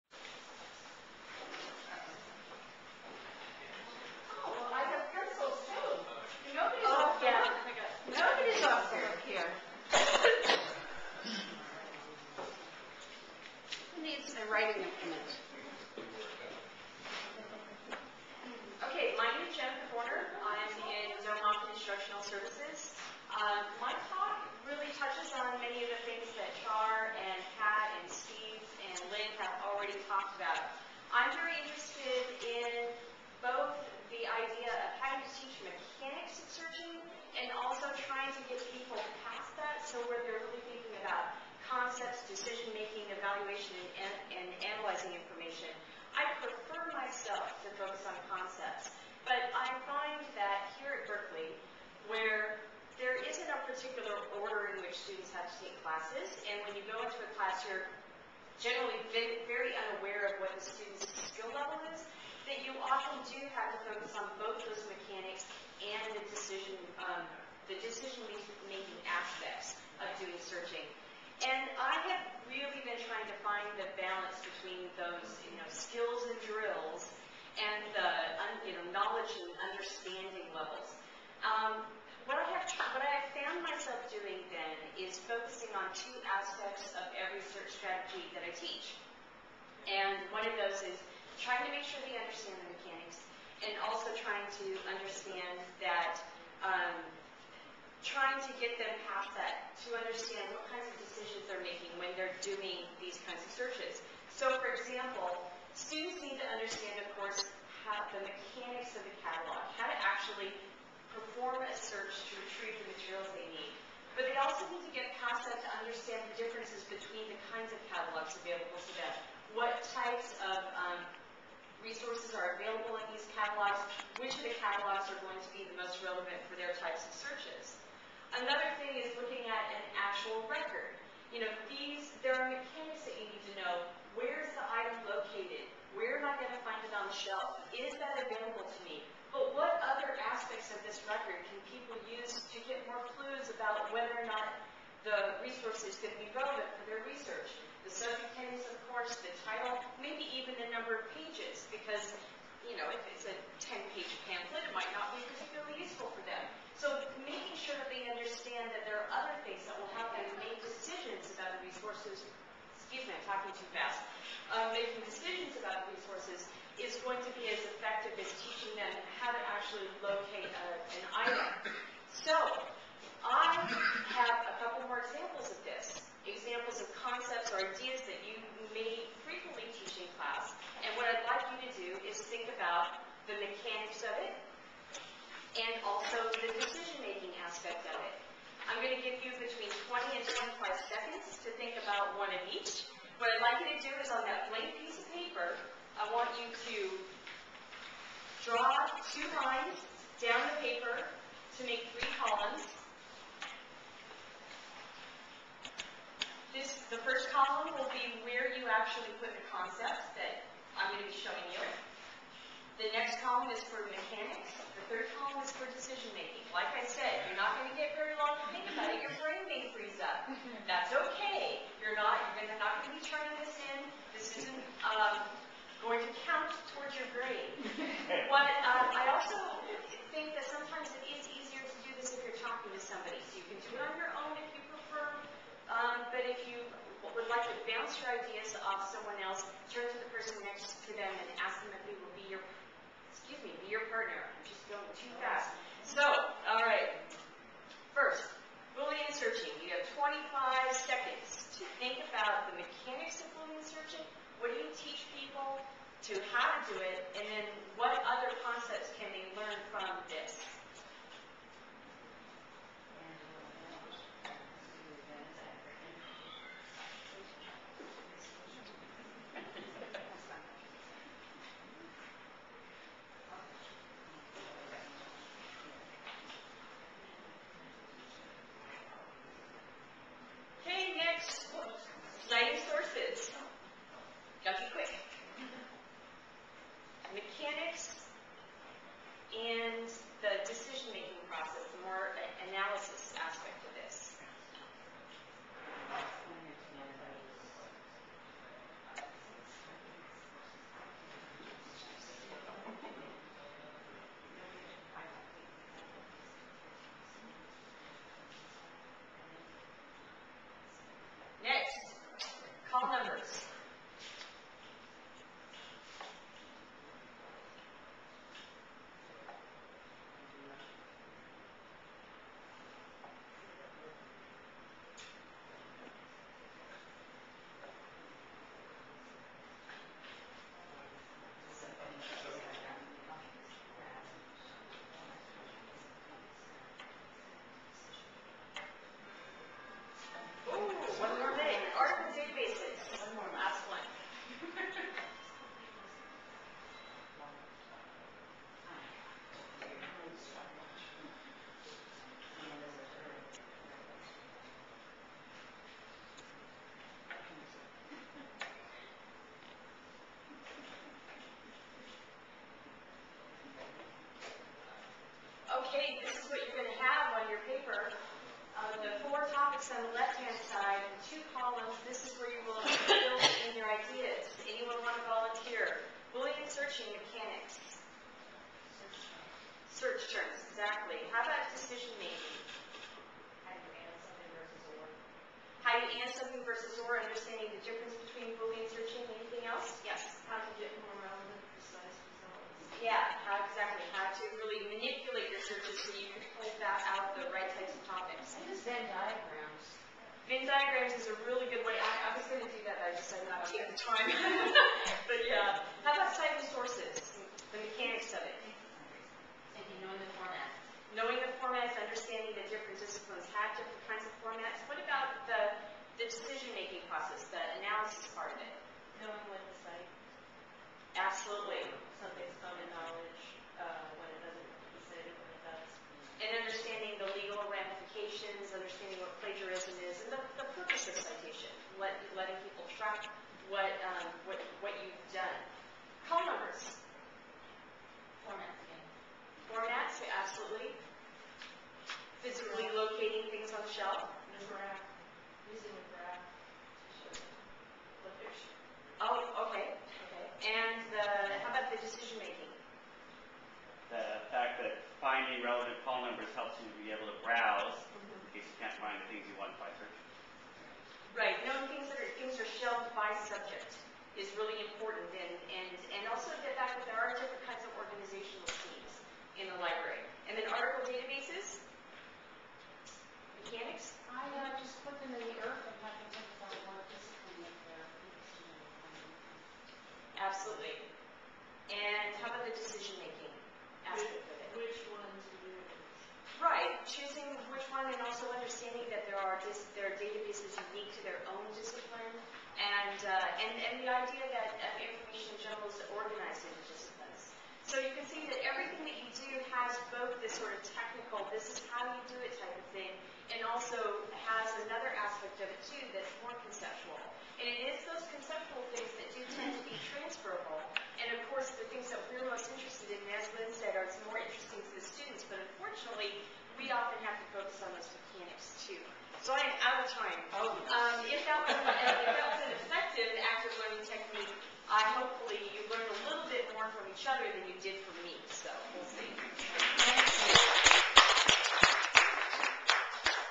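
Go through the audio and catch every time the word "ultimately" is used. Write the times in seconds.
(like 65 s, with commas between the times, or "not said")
not said.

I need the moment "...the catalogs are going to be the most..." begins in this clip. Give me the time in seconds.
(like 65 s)
124 s.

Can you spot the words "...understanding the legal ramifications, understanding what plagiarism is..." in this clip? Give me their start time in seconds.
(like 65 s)
426 s.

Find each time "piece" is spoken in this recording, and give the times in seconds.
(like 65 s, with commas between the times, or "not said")
194 s.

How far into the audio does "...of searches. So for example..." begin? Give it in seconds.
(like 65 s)
103 s.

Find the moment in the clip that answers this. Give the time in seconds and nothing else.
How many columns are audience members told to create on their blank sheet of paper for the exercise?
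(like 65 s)
201 s.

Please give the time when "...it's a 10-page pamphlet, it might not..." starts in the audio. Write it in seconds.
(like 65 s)
153 s.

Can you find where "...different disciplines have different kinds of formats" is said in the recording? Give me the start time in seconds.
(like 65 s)
412 s.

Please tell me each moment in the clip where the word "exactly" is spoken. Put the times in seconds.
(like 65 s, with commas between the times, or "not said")
380 s, 393 s.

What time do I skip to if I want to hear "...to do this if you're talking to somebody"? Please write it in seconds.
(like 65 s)
231 s.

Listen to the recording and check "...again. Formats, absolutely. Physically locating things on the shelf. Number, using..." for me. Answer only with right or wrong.
right.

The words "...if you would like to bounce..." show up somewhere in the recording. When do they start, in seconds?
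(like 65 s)
236 s.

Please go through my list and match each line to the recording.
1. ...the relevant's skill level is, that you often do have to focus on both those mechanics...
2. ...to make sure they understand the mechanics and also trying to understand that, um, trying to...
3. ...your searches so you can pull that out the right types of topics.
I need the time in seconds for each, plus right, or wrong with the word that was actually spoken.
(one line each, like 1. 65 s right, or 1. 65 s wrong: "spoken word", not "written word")
1. 60 s wrong: "student", not "relevant"
2. 91 s right
3. 395 s right.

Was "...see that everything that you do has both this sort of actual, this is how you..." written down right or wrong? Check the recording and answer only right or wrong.
wrong.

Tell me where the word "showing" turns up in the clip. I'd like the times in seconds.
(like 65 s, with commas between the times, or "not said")
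211 s.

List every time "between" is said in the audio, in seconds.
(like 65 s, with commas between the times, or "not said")
74 s, 116 s, 189 s, 388 s.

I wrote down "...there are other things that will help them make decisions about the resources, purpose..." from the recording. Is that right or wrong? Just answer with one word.
wrong.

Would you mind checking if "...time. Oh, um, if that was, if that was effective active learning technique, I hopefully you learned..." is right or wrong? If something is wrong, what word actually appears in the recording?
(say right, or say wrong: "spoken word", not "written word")
right.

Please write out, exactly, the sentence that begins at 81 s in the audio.
Um, what I have, what I have found myself doing then focusing on two aspects of every search strategy that I teach.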